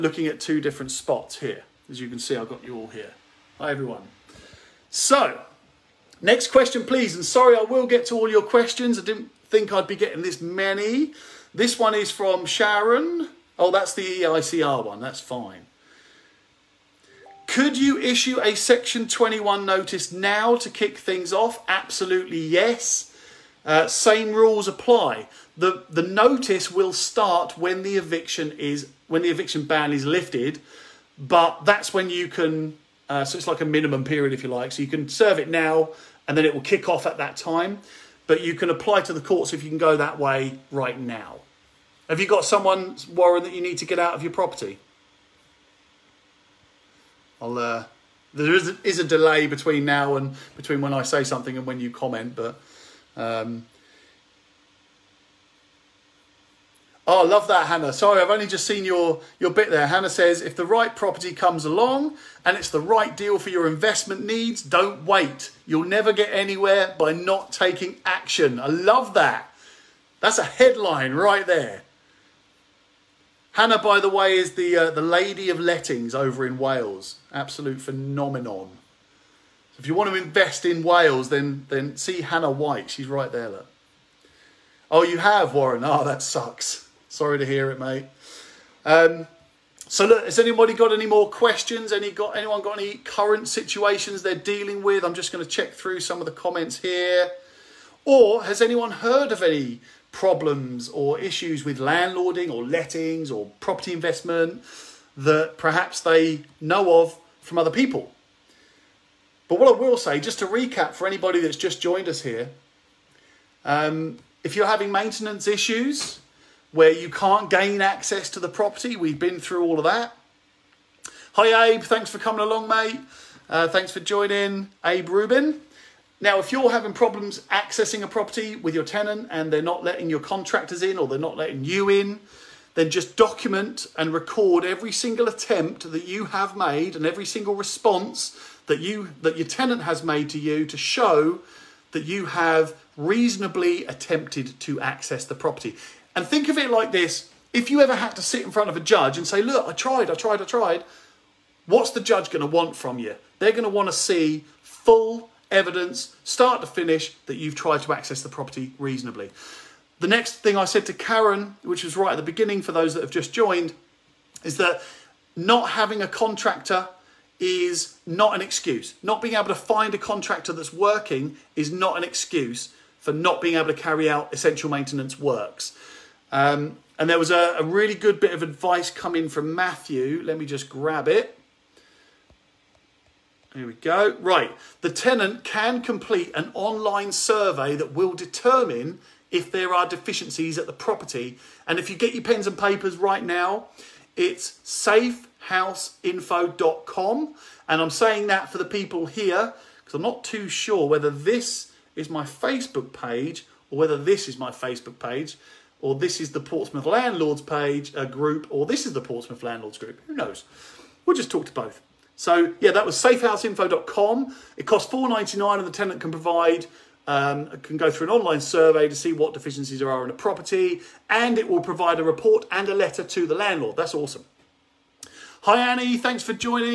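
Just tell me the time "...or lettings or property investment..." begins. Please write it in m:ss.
1:42.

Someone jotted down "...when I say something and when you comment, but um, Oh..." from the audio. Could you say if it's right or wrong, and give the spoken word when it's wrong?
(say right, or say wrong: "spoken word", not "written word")
right.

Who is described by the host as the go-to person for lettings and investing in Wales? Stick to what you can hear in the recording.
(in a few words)
Hannah White.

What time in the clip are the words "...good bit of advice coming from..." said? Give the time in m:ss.
2:57.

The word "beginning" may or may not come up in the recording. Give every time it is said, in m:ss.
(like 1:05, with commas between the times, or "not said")
2:42.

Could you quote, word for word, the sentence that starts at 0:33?
Uh, so it's like a minimum period, if you like.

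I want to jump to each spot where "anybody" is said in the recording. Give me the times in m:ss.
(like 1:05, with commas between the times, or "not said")
1:30, 1:51.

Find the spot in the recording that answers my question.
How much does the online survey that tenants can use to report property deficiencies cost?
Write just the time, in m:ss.
3:34.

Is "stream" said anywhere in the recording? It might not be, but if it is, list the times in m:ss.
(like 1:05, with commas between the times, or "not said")
not said.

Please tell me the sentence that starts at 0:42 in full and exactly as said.
Have you got someone, Warren, that you need to get out of your property?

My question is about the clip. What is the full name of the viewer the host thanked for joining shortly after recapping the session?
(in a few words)
Abe Rubin.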